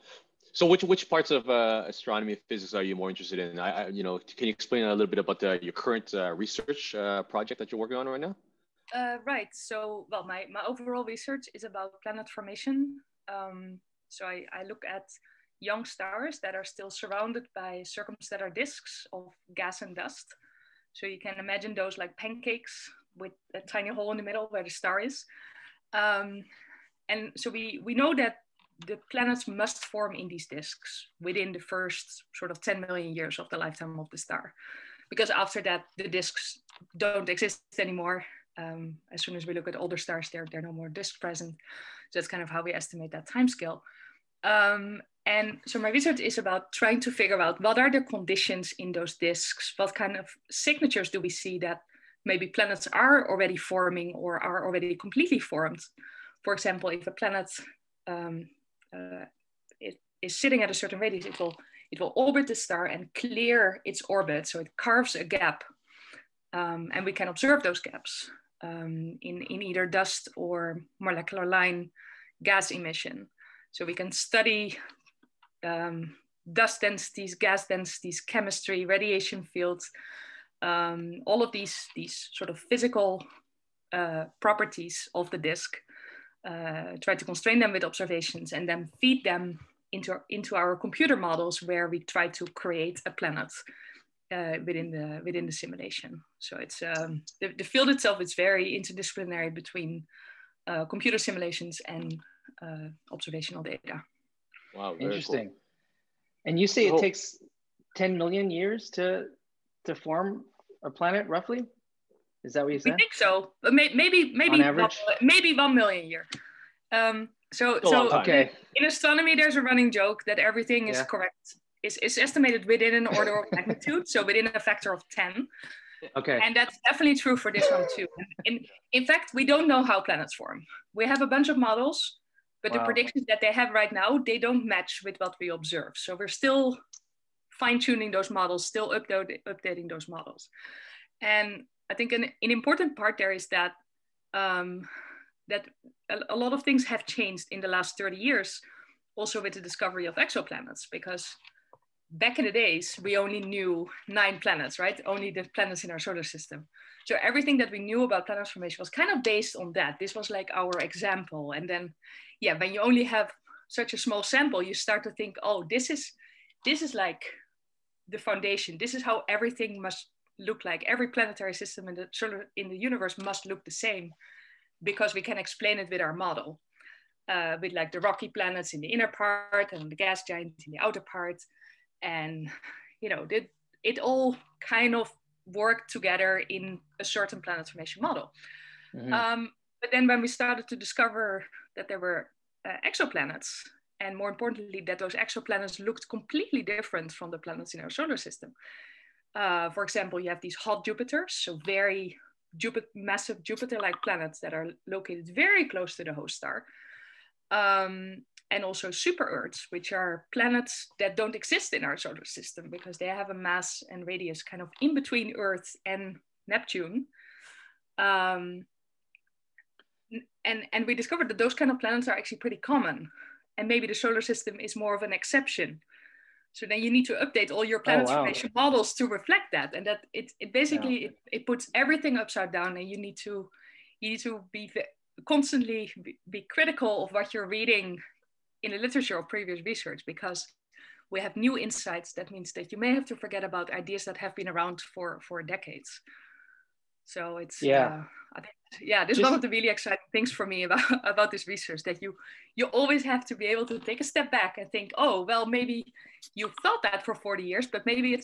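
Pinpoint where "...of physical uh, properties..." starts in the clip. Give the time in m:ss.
1:22.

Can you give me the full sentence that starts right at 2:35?
Only the planets in our solar system.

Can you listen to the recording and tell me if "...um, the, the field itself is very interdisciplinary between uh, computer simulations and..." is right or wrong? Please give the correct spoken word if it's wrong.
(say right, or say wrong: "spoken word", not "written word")
right.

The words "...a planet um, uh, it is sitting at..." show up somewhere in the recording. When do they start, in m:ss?
0:57.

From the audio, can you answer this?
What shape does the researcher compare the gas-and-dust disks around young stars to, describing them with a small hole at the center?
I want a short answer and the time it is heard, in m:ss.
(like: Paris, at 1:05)
Pancakes, at 0:22.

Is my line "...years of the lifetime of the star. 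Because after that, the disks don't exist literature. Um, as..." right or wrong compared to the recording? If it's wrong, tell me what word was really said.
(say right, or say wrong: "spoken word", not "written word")
wrong: "anymore", not "literature".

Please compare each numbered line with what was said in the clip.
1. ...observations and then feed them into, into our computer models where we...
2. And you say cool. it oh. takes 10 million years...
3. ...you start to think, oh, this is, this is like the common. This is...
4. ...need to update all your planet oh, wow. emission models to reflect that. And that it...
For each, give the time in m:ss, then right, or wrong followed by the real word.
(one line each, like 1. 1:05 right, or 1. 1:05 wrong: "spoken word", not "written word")
1. 1:27 right
2. 1:46 right
3. 2:44 wrong: "foundation", not "common"
4. 3:46 wrong: "formation", not "emission".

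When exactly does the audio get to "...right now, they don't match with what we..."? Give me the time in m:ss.
2:13.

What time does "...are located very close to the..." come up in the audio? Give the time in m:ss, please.
3:24.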